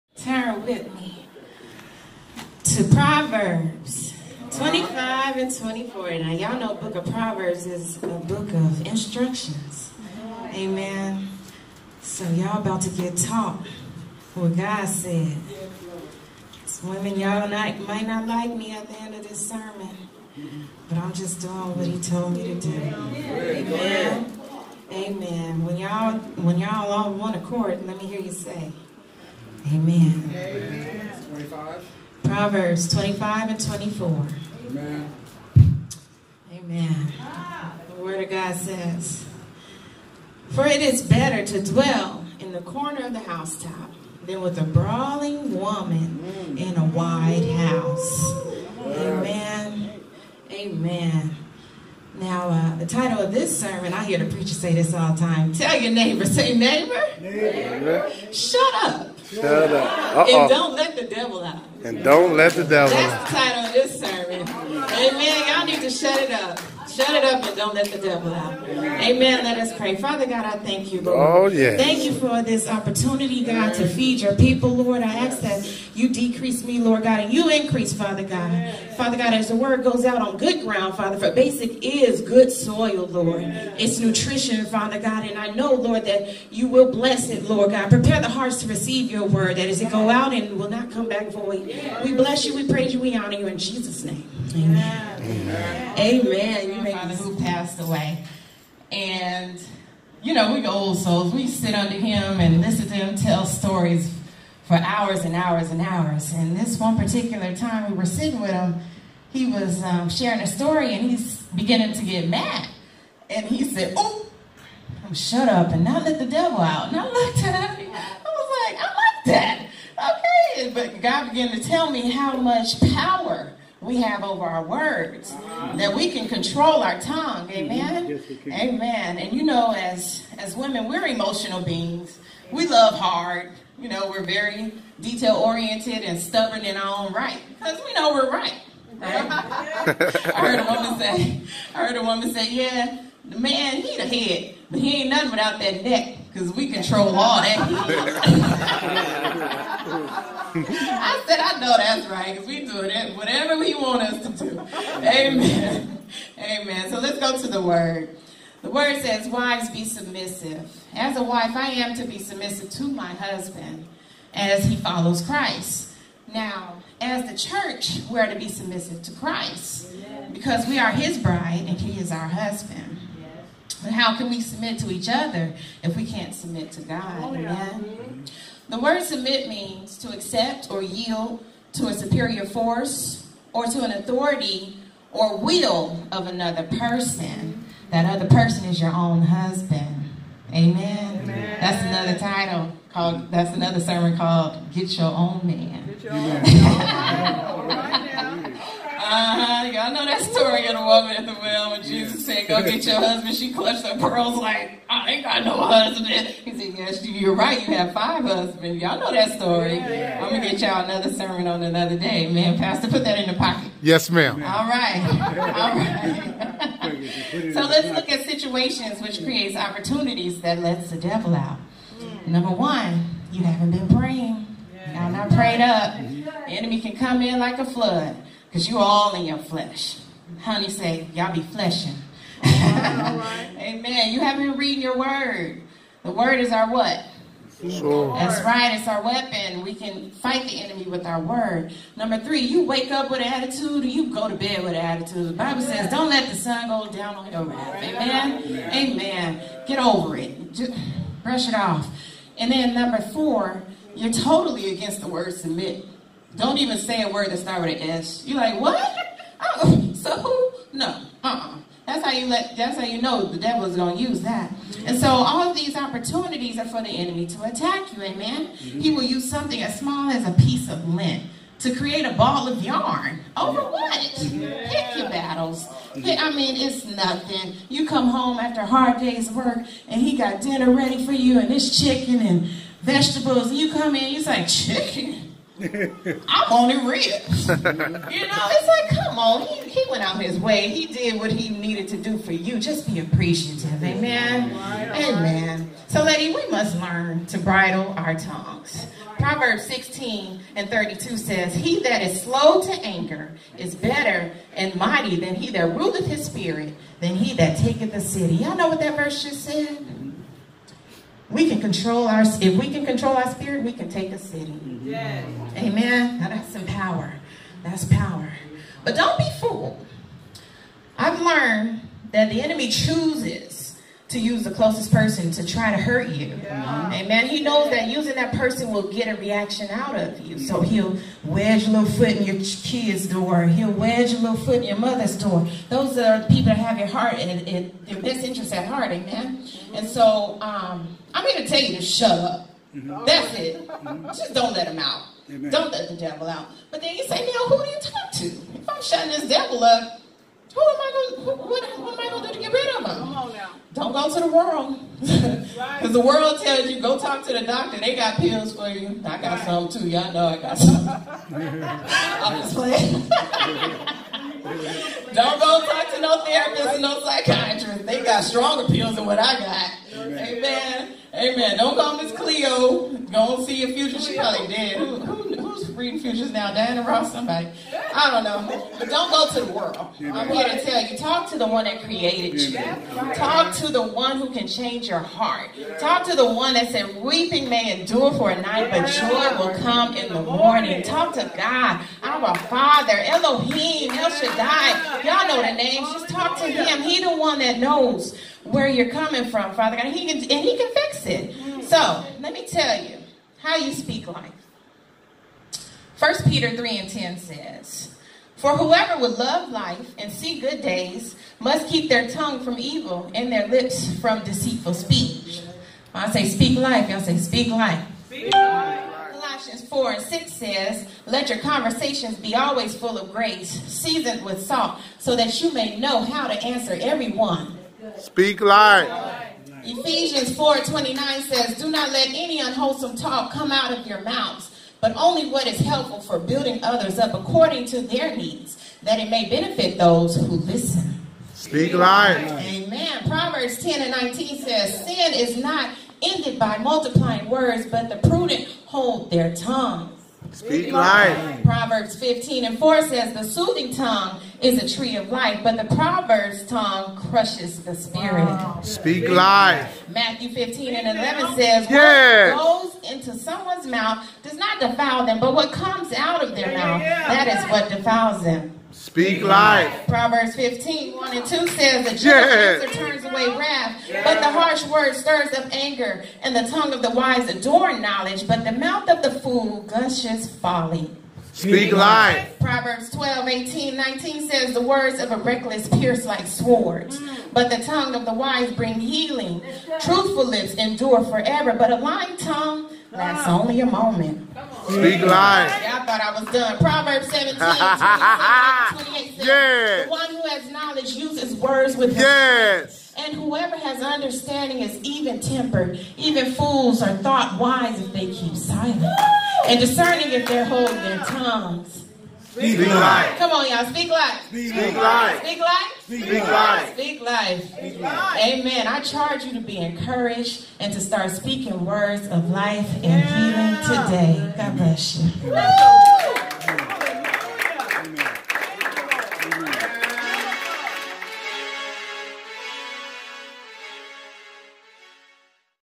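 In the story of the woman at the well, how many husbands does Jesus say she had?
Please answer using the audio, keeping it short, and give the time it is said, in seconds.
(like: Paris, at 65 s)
5, at 207 s.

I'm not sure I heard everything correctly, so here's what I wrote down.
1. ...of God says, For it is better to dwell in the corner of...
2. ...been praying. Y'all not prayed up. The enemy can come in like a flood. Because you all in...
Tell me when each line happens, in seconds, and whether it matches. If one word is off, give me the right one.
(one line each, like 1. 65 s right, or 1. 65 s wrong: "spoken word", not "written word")
1. 38 s right
2. 223 s right.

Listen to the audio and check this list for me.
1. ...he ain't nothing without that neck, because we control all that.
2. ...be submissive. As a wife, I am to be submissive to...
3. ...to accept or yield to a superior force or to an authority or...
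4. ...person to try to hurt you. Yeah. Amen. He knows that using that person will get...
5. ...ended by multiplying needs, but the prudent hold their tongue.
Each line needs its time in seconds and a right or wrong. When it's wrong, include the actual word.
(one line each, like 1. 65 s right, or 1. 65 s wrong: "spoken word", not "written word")
1. 144 s right
2. 159 s right
3. 179 s right
4. 324 s right
5. 446 s wrong: "words", not "needs".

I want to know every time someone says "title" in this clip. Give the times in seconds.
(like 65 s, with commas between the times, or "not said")
52 s, 63 s, 192 s.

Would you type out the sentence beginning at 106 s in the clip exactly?
And this one particular time we were sitting with him, he was um, sharing a story and he's beginning to get mad.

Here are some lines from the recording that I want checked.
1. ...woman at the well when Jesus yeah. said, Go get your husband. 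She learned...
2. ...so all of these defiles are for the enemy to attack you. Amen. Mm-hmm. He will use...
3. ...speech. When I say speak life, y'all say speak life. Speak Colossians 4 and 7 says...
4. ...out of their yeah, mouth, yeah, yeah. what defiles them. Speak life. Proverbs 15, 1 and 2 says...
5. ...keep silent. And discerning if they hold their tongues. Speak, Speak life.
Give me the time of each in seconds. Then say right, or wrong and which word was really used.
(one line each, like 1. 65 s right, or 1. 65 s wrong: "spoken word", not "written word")
1. 200 s wrong: "clutched", not "learned"
2. 264 s wrong: "opportunities", not "defiles"
3. 414 s wrong: "6", not "7"
4. 465 s right
5. 508 s right.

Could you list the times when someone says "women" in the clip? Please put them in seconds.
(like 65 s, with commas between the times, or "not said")
16 s, 130 s.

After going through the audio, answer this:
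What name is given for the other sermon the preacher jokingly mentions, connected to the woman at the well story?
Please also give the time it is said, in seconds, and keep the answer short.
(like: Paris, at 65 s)
Get Your Own Man, at 194 s.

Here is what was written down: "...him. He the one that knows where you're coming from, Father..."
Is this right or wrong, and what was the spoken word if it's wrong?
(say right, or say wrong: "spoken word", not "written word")
right.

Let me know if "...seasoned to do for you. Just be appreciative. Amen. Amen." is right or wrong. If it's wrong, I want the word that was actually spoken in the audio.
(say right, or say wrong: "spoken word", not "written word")
wrong: "needed", not "seasoned".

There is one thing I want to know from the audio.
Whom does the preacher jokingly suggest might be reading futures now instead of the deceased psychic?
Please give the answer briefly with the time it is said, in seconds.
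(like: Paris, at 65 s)
Diana Ross, at 376 s.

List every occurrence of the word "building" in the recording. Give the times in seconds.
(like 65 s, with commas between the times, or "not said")
436 s.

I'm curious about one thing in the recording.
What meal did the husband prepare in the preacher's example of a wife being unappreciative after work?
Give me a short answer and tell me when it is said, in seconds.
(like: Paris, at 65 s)
chicken and vegetables, at 281 s.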